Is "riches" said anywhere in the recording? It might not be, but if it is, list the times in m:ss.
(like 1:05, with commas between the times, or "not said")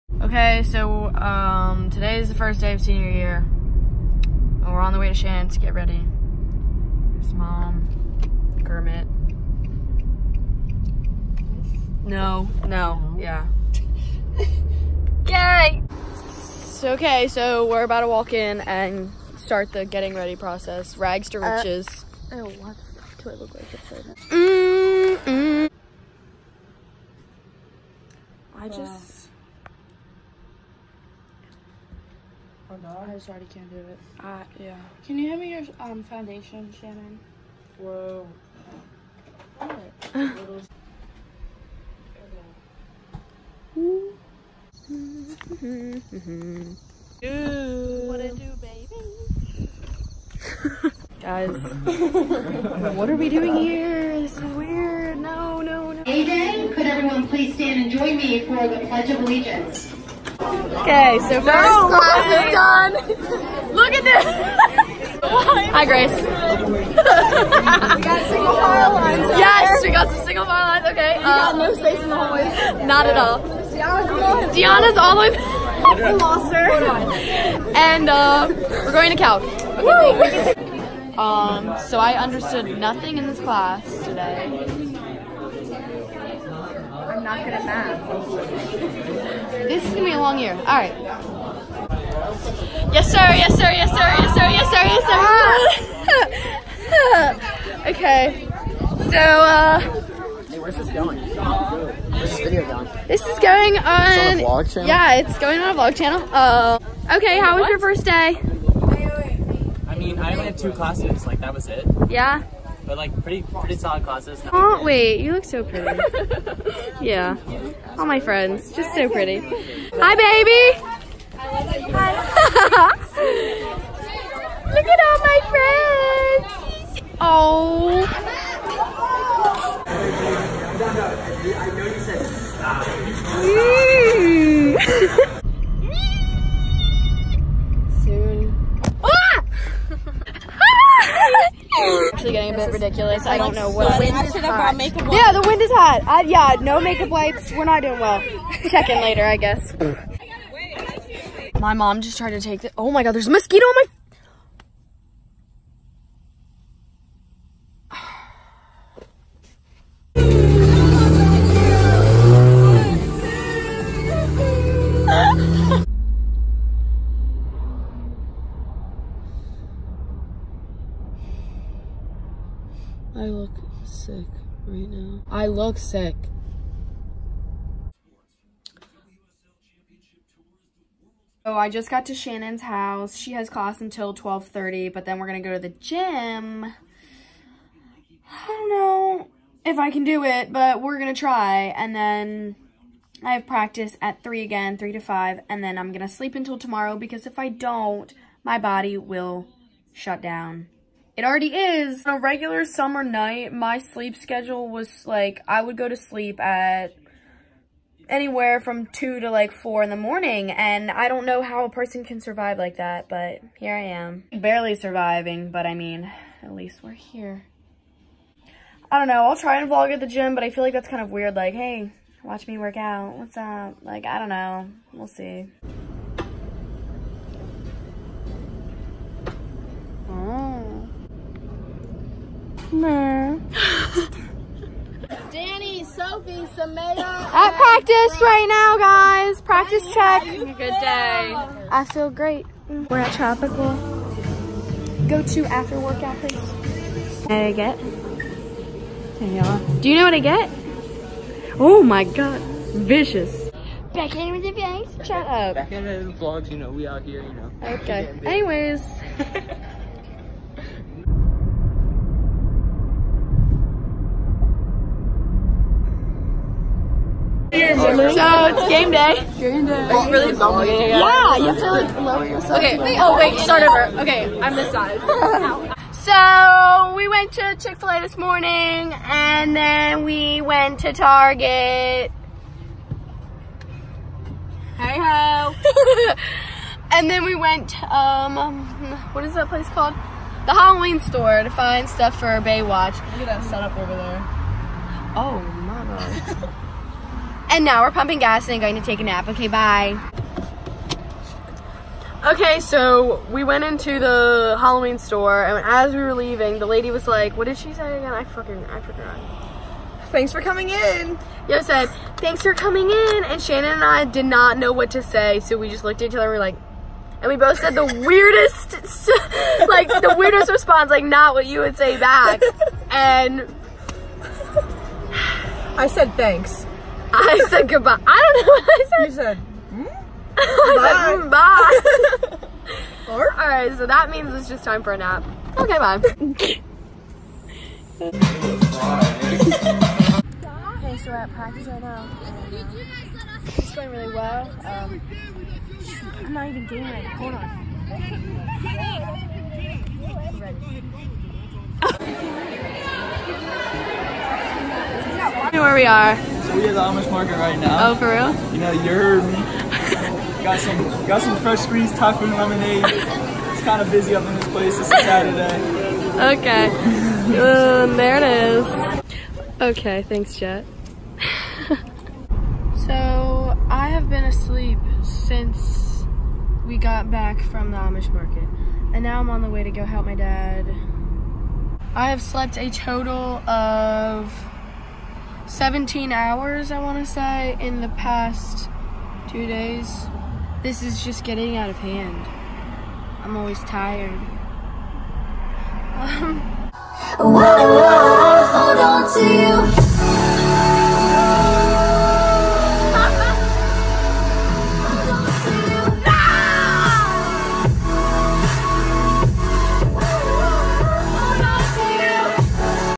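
0:21.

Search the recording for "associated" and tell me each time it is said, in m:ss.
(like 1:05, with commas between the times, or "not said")
not said.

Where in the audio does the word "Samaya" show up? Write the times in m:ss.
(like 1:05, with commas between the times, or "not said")
3:56.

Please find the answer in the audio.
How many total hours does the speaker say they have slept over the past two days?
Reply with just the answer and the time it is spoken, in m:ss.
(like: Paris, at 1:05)
17, at 6:25.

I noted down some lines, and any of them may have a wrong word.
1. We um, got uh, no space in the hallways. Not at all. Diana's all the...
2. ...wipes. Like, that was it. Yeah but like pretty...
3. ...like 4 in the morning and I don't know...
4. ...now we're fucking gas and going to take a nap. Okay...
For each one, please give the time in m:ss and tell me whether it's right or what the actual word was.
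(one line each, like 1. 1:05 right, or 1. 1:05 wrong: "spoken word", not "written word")
1. 1:11 right
2. 1:50 wrong: "classes", not "wipes"
3. 3:29 right
4. 4:57 wrong: "pumping", not "fucking".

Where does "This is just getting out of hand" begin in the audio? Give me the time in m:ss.
6:30.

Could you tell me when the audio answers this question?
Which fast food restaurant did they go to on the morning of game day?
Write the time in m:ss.
4:37.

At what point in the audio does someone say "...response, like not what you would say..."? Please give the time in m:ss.
5:20.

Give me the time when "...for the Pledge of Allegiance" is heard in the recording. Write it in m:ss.
0:58.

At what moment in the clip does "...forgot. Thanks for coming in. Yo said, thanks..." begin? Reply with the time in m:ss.
5:08.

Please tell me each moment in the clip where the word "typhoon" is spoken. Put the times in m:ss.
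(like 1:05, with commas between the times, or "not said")
6:01.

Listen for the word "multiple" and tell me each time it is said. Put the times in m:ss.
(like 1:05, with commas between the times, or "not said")
not said.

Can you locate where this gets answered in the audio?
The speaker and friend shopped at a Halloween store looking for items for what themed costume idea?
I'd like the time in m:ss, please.
4:52.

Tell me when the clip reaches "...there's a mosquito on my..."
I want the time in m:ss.
2:33.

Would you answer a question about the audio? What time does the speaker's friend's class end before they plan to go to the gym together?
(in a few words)
12:30.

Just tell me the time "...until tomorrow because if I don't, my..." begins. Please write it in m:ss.
3:16.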